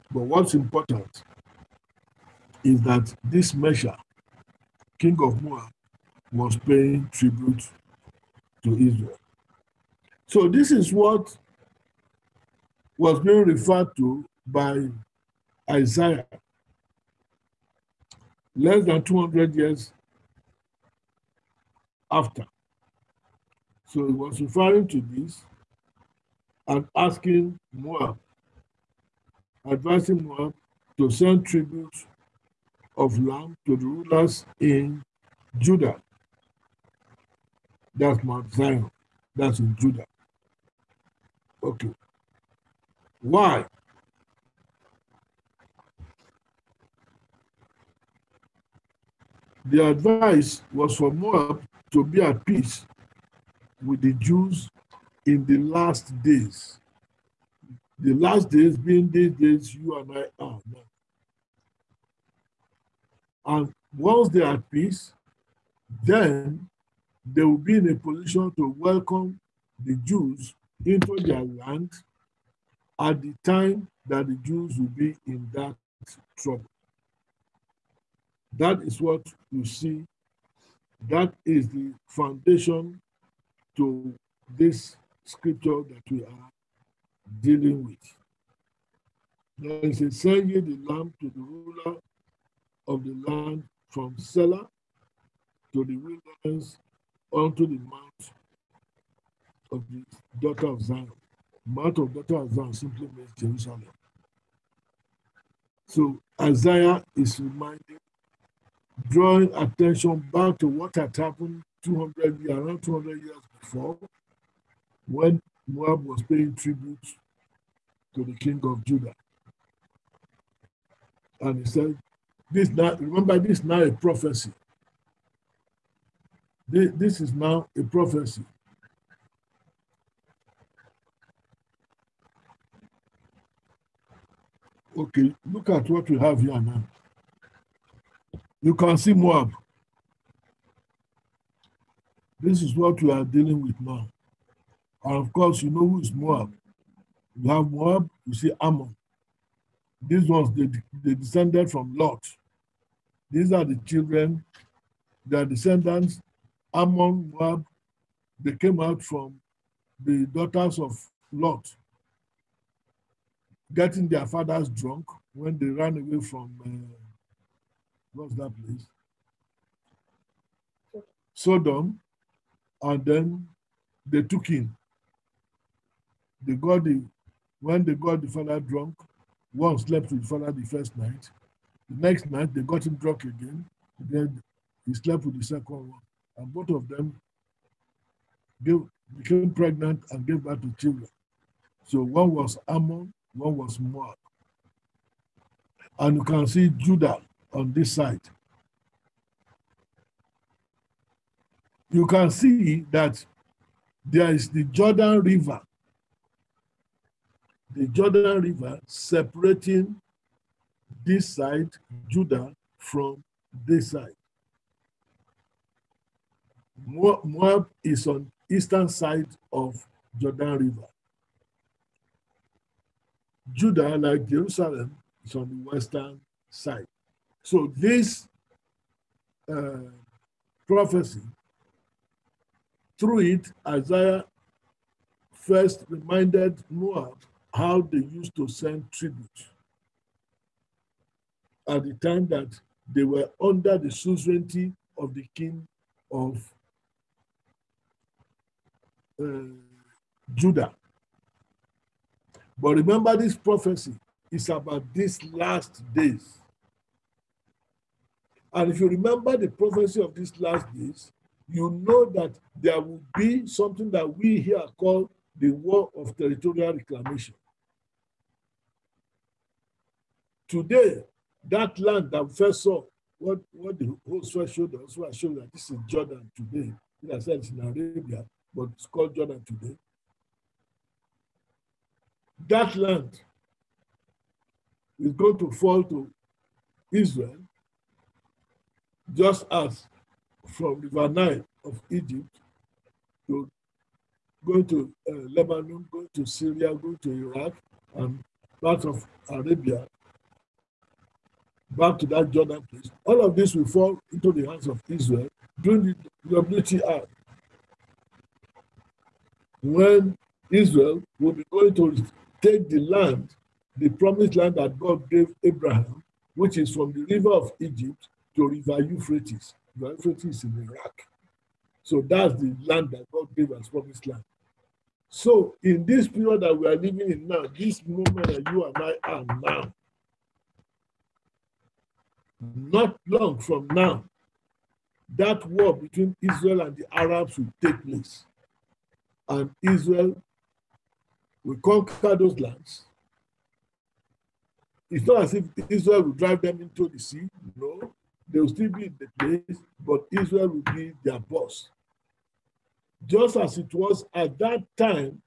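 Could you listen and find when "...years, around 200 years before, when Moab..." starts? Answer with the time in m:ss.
1:52.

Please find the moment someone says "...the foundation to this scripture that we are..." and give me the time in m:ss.
1:21.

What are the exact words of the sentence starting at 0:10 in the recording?
So this is what was being referred to by Isaiah less than 200 years after.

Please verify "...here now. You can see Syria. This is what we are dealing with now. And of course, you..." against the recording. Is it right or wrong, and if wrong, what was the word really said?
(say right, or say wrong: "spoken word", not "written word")
wrong: "Moab", not "Syria".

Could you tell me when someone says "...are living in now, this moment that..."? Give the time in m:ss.
5:26.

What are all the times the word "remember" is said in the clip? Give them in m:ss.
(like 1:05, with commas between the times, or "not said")
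2:02, 4:12, 4:18.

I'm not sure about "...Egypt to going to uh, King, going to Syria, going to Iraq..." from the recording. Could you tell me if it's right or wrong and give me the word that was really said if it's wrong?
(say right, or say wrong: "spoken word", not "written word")
wrong: "Lebanon", not "King".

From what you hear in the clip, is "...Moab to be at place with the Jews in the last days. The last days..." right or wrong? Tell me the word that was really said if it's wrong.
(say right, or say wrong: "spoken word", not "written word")
wrong: "peace", not "place".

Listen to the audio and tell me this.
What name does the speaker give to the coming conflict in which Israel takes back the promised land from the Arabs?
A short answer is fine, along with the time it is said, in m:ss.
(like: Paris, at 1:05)
War of territorial reclamation, at 4:25.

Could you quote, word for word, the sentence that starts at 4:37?
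In a sense, in Arabia, but it's called Jordan today.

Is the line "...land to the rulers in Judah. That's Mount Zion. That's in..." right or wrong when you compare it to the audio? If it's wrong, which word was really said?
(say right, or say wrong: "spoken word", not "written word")
right.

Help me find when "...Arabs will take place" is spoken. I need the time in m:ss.
5:36.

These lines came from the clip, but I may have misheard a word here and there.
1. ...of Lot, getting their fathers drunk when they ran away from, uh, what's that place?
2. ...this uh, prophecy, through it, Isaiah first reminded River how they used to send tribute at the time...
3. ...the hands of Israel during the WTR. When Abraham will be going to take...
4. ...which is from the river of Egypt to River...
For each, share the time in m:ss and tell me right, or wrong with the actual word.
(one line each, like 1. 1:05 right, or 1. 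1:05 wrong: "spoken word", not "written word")
1. 2:40 right
2. 3:47 wrong: "Moab", not "River"
3. 5:04 wrong: "Israel", not "Abraham"
4. 5:16 right.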